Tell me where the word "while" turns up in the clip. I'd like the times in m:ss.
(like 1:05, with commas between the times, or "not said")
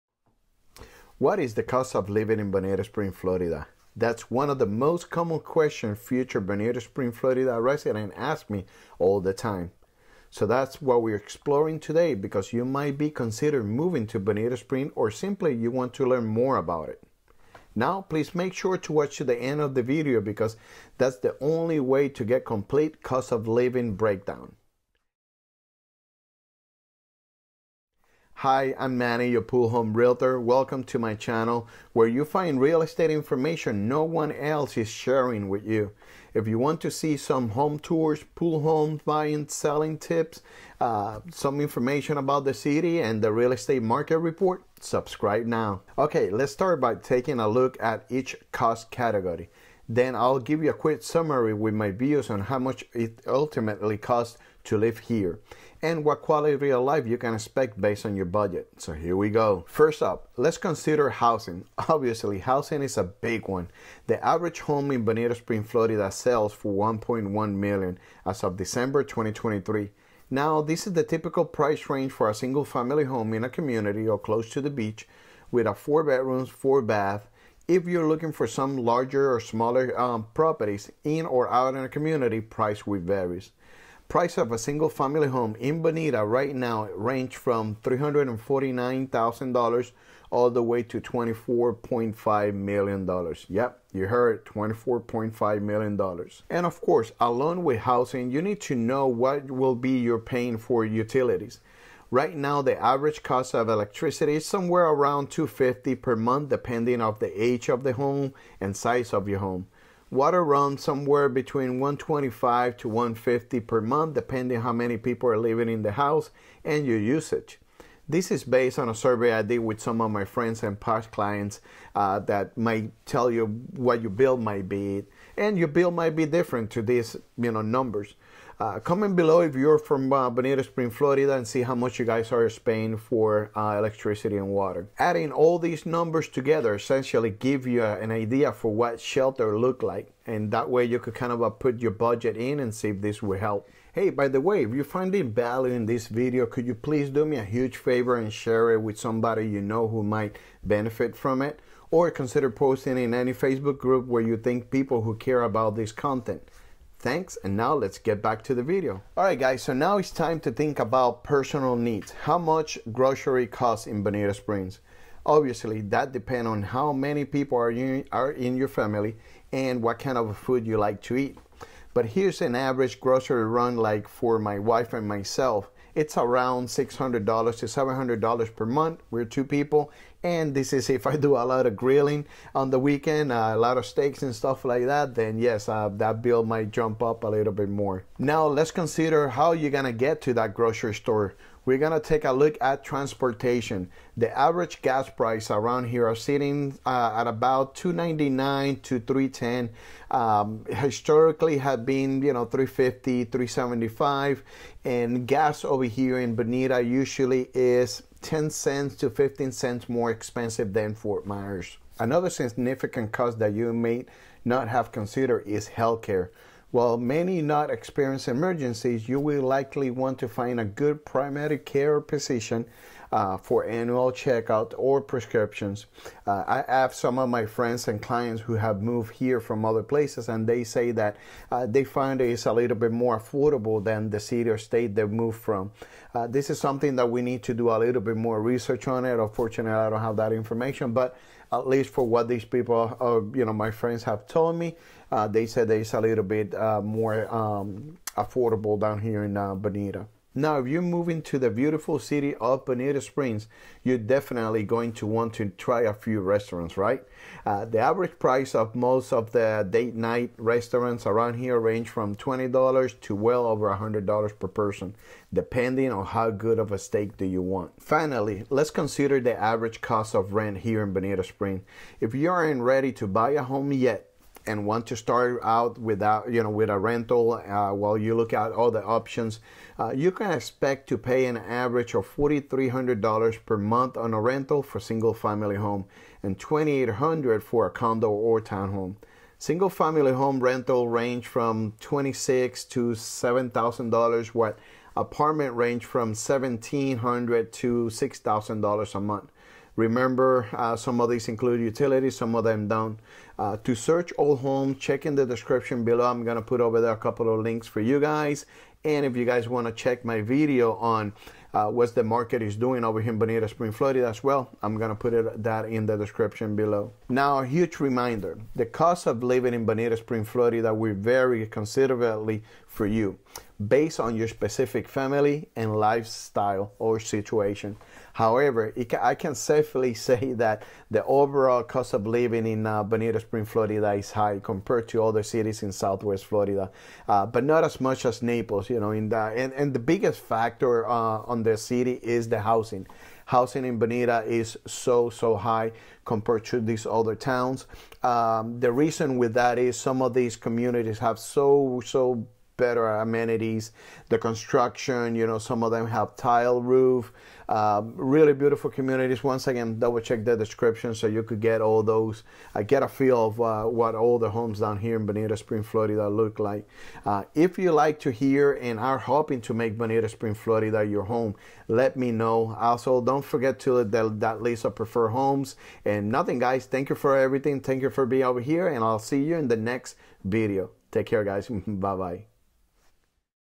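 3:36, 4:37.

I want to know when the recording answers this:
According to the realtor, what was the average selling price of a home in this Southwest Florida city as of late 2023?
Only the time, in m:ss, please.
1:06.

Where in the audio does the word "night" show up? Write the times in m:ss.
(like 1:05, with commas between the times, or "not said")
4:19.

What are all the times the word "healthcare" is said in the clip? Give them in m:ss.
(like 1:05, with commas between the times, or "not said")
3:35.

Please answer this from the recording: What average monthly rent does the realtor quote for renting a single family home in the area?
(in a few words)
$4,300.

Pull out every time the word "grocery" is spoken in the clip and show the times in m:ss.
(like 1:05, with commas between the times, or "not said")
2:42, 2:53, 3:10.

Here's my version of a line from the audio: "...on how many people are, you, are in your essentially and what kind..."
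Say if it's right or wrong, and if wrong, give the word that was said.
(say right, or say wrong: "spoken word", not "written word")
wrong: "family", not "essentially".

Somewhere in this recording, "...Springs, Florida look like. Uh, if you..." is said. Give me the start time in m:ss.
6:05.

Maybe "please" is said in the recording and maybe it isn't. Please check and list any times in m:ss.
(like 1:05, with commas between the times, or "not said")
0:18, 2:26.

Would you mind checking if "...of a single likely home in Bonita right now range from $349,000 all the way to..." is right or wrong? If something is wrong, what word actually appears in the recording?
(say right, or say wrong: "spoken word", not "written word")
wrong: "family", not "likely".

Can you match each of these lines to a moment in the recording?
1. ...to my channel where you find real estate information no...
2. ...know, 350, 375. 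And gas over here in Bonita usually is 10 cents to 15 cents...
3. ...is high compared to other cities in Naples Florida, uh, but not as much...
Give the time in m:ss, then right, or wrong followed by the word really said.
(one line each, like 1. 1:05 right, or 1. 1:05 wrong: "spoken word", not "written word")
1. 0:30 right
2. 3:22 right
3. 5:33 wrong: "Southwest", not "Naples".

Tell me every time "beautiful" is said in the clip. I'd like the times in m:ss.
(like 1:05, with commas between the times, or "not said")
4:11, 5:58.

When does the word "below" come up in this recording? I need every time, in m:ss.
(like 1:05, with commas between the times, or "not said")
2:09, 5:05, 5:16.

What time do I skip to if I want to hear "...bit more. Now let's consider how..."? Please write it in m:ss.
3:07.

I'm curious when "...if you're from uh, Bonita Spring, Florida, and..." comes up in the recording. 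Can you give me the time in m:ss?
2:09.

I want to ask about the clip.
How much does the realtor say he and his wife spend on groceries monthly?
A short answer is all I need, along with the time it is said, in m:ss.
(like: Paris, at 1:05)
$600 to $700, at 2:56.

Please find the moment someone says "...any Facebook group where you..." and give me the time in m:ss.
2:33.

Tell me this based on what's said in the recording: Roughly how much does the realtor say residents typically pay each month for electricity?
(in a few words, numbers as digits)
$250.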